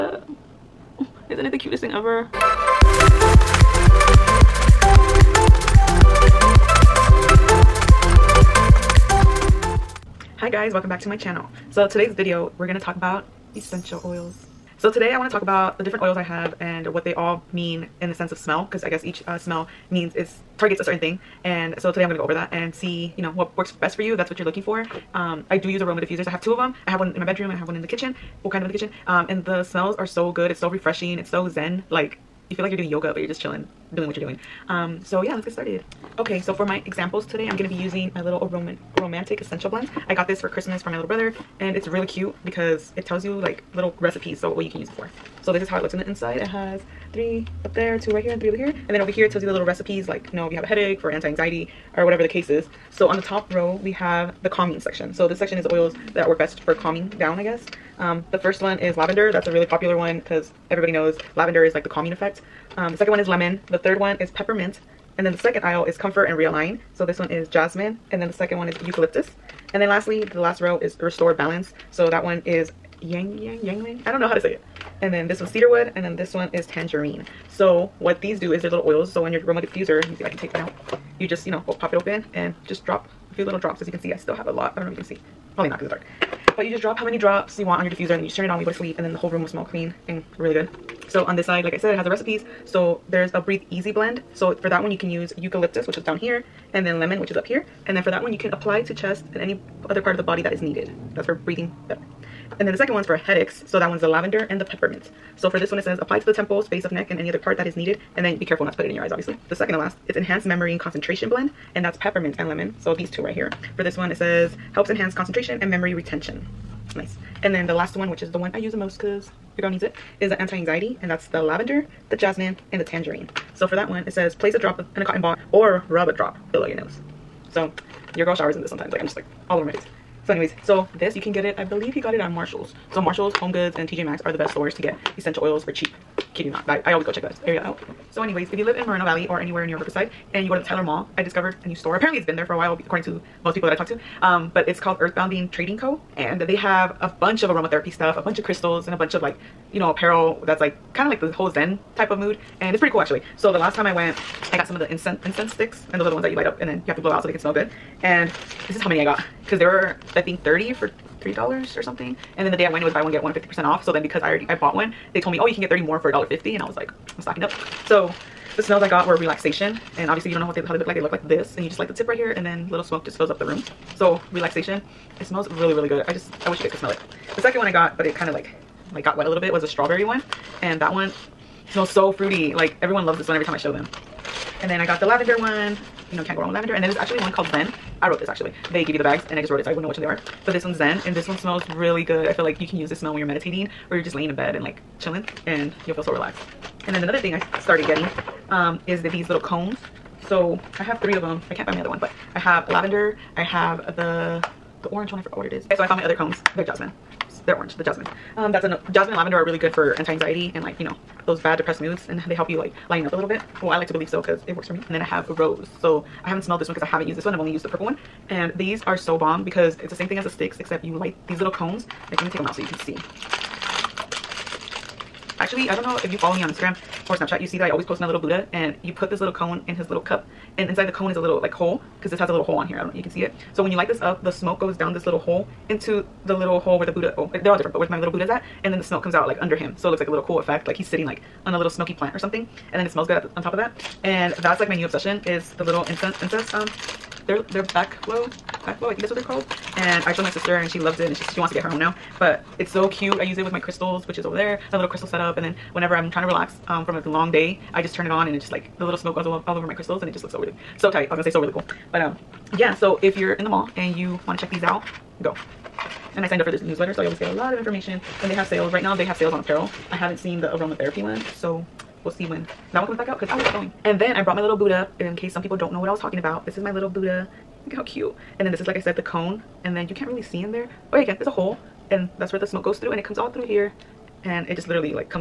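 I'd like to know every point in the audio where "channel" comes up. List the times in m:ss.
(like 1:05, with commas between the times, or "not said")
0:11.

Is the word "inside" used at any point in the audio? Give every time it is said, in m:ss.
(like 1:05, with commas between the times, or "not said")
0:46, 3:50.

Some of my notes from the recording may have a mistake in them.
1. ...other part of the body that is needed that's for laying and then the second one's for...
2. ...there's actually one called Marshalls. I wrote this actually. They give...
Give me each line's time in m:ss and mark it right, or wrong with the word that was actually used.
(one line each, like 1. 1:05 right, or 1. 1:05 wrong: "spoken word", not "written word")
1. 1:39 wrong: "breathing", not "laying"
2. 3:06 wrong: "Zen", not "Marshalls".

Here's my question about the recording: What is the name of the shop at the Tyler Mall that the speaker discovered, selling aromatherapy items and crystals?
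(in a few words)
Earthbound Trading Co.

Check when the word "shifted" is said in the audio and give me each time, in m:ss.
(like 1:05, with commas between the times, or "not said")
not said.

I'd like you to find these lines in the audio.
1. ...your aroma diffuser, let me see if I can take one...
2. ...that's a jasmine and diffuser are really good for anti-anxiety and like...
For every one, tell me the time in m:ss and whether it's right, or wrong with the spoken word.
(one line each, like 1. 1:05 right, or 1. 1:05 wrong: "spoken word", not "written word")
1. 1:19 right
2. 3:28 wrong: "lavender", not "diffuser".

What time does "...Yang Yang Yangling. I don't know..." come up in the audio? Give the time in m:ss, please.
1:13.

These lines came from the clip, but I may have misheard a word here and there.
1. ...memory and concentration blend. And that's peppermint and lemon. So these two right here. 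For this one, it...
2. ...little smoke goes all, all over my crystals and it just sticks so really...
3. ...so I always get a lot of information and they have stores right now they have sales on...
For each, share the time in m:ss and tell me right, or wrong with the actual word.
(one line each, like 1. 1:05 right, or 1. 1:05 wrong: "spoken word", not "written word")
1. 1:50 right
2. 4:18 wrong: "looks", not "sticks"
3. 4:26 wrong: "sales", not "stores".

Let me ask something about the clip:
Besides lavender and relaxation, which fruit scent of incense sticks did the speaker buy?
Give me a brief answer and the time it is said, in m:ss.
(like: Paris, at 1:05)
Strawberry, at 2:59.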